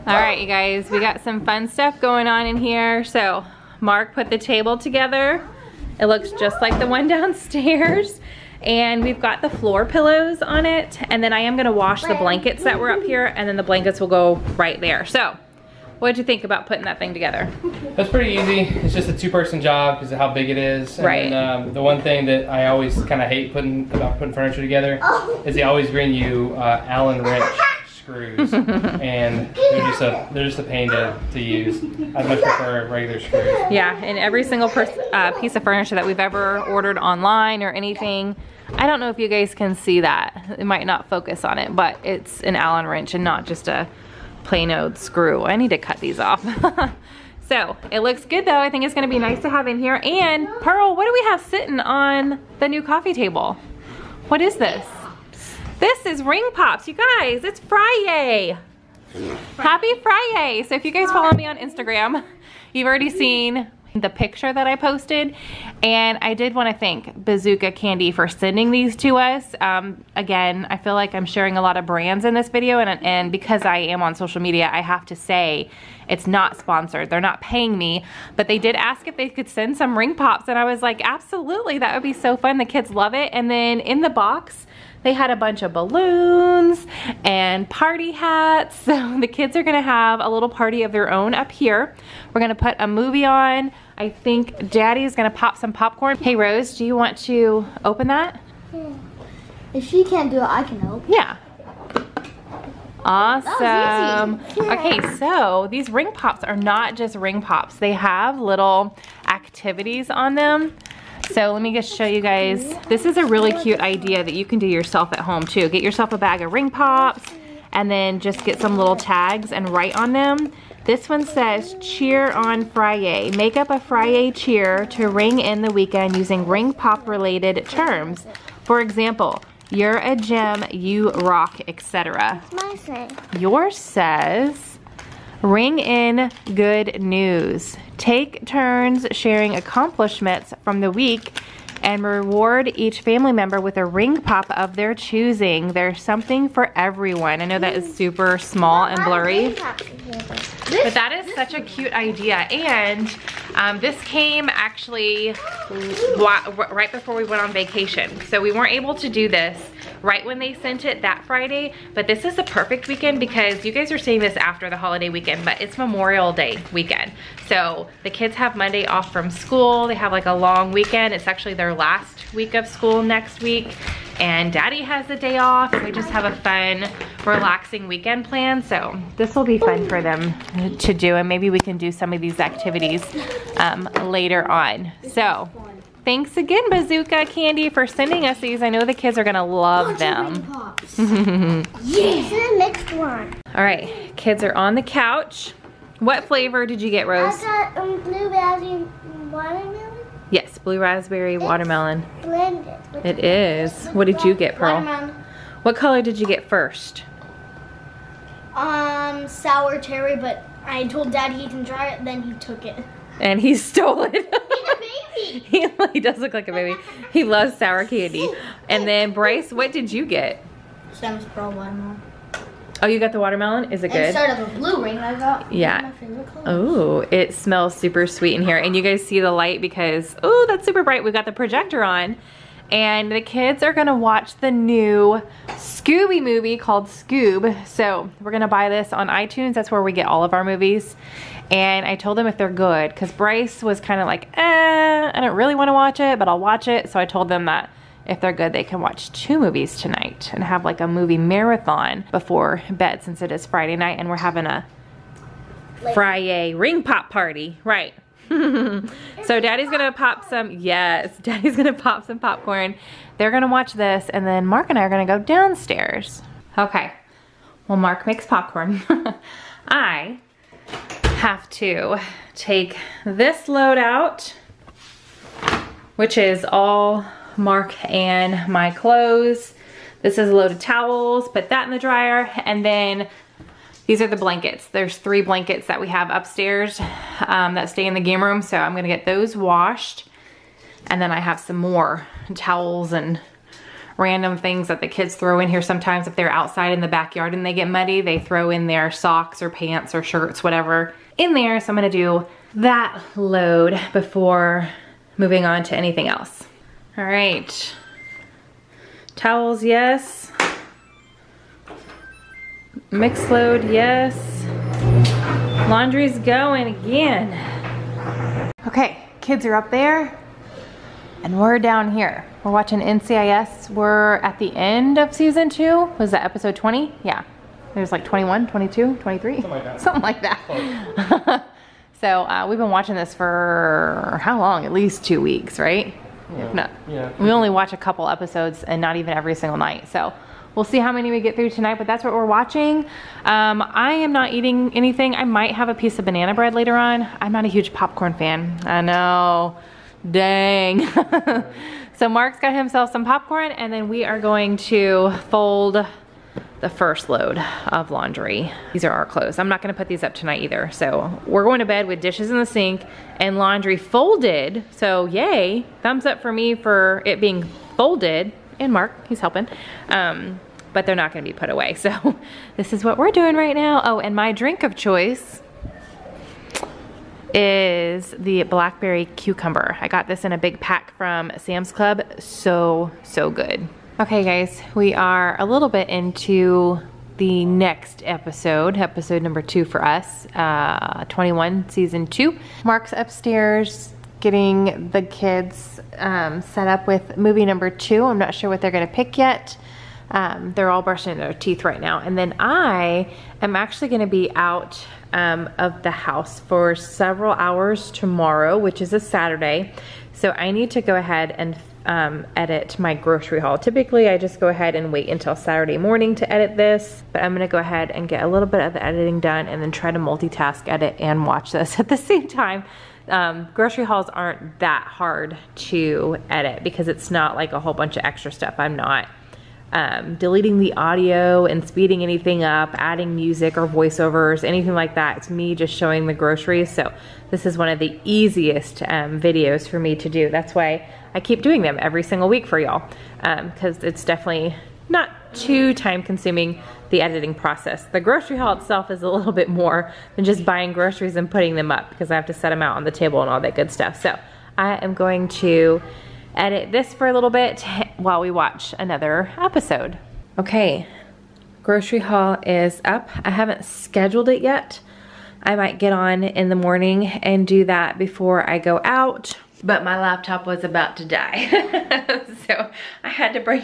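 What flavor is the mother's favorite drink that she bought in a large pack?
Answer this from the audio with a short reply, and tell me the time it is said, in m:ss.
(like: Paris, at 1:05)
Blackberry cucumber, at 6:18.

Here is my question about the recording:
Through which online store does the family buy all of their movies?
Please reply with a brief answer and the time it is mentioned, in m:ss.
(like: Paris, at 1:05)
iTunes, at 3:59.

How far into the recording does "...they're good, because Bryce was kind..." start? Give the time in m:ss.
4:02.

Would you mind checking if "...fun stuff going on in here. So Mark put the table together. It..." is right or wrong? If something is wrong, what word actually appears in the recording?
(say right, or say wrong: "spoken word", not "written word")
right.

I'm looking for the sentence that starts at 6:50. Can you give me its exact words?
So I need to go ahead and um, edit my grocery haul.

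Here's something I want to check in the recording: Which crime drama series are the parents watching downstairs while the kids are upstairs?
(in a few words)
NCIS.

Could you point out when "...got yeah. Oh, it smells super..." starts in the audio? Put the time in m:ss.
3:45.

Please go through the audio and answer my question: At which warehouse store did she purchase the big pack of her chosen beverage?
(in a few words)
Sam's Club.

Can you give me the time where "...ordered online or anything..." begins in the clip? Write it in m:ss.
0:36.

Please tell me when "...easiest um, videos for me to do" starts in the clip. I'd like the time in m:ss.
7:18.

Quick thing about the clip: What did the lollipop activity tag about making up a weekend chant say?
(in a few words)
Cheer on Friday.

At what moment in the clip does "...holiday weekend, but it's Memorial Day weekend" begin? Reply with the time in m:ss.
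2:44.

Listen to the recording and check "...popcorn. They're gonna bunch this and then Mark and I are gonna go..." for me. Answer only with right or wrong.
wrong.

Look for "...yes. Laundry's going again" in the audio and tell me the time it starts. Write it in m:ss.
5:13.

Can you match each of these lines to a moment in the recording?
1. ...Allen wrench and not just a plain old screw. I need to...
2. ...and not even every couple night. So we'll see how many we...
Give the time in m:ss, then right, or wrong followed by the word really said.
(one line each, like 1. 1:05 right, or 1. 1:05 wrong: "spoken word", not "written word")
1. 0:42 right
2. 5:38 wrong: "single", not "couple".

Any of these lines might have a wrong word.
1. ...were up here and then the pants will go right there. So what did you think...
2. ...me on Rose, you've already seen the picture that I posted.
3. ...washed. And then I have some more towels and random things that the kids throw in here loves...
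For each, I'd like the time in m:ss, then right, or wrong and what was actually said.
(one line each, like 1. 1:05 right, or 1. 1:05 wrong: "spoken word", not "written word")
1. 0:12 wrong: "blankets", not "pants"
2. 1:01 wrong: "Instagram", not "Rose"
3. 4:49 wrong: "sometimes", not "loves".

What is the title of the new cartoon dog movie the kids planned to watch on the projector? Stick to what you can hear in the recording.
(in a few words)
Scoob.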